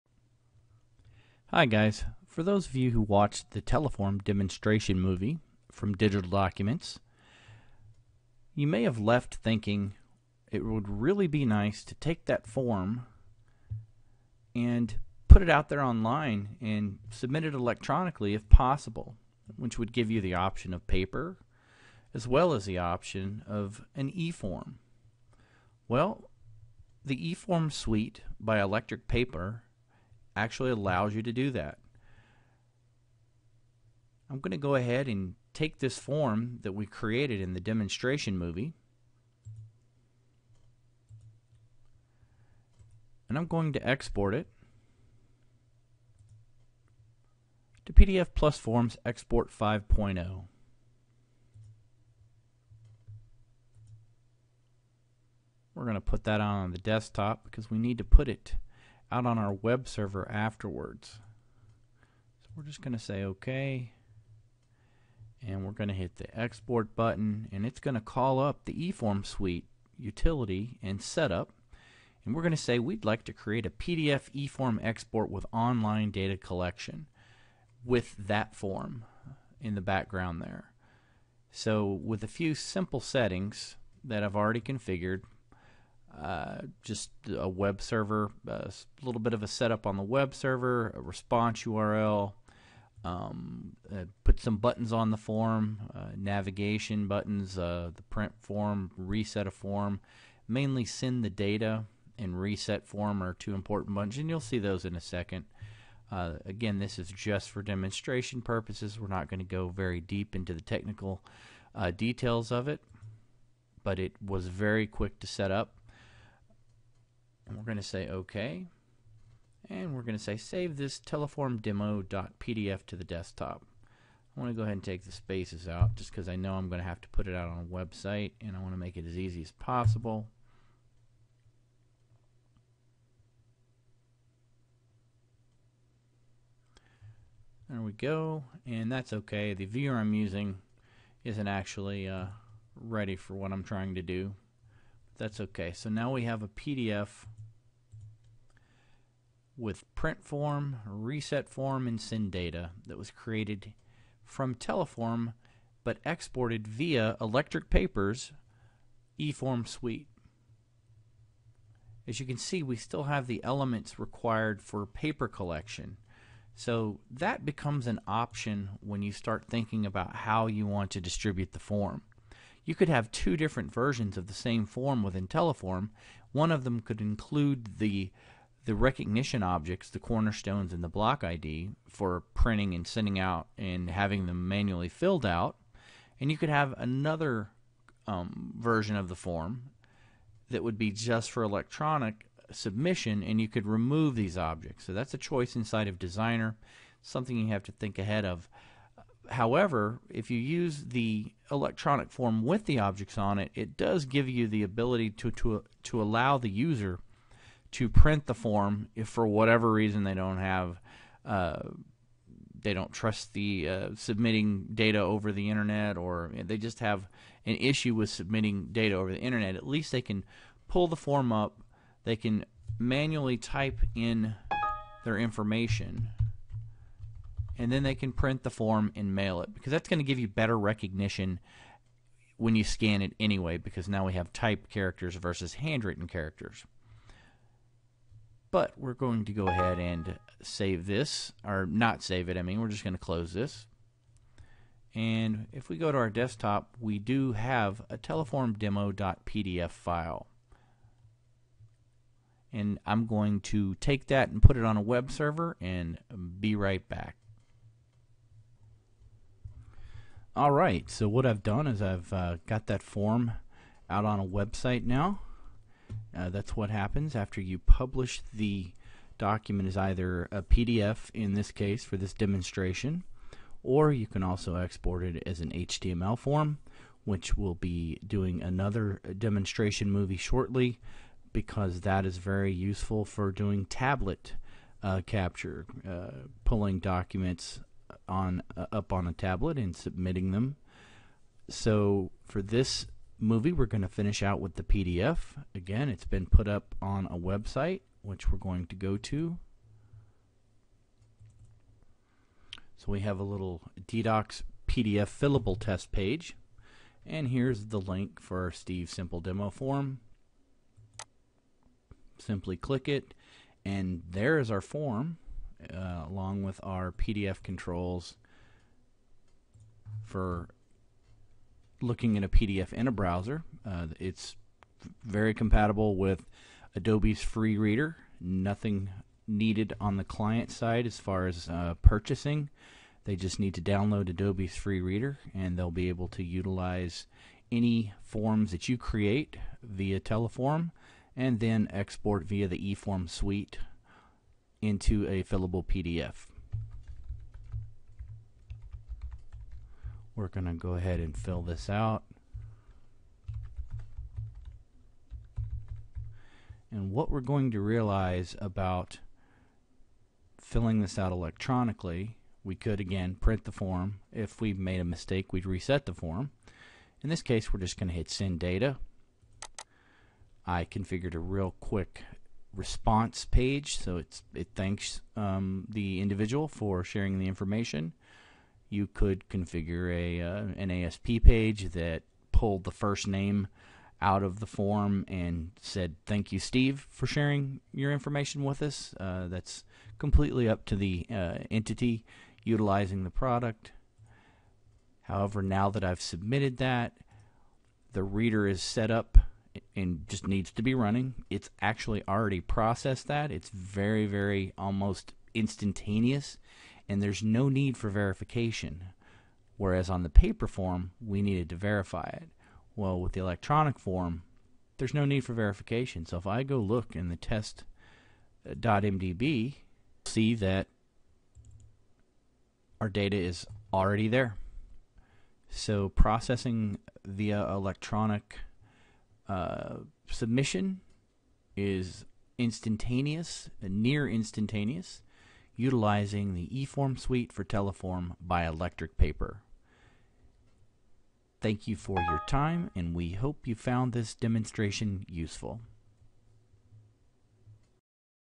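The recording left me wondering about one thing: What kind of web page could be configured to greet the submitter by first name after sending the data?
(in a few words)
ASP page.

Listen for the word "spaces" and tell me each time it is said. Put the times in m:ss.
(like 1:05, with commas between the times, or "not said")
2:05.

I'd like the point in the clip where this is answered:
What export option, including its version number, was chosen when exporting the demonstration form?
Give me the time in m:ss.
0:47.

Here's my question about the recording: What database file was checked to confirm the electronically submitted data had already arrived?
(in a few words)
test.mdb.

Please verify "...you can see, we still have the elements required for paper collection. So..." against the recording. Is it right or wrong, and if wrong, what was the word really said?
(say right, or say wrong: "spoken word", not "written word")
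right.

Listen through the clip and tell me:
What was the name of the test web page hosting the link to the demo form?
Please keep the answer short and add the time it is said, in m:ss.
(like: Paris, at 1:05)
DDocs PDF fillable test page, at 5:03.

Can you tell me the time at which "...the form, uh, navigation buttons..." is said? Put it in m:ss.
1:35.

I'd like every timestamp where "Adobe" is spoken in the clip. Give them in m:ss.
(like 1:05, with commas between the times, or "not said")
5:26, 5:34.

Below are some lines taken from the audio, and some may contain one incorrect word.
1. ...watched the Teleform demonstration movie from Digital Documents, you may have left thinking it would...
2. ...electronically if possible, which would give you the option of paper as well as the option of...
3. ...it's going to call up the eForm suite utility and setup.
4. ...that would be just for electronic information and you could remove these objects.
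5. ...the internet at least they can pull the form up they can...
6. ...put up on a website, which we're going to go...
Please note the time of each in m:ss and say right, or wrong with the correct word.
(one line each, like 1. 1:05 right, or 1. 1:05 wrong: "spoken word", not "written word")
1. 0:03 right
2. 0:17 right
3. 1:07 right
4. 3:10 wrong: "submission", not "information"
5. 3:39 right
6. 4:56 right.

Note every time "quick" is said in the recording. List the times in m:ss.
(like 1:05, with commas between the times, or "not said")
1:54, 6:11.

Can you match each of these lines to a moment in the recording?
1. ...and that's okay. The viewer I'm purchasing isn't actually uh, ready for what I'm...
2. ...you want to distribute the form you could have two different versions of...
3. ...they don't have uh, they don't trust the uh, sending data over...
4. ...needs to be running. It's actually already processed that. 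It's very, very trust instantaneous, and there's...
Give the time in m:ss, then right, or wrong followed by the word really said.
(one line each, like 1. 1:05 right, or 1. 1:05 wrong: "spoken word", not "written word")
1. 2:18 wrong: "using", not "purchasing"
2. 2:50 right
3. 3:30 wrong: "submitting", not "sending"
4. 6:40 wrong: "almost", not "trust".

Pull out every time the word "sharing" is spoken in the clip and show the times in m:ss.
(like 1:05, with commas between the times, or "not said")
6:16, 6:27.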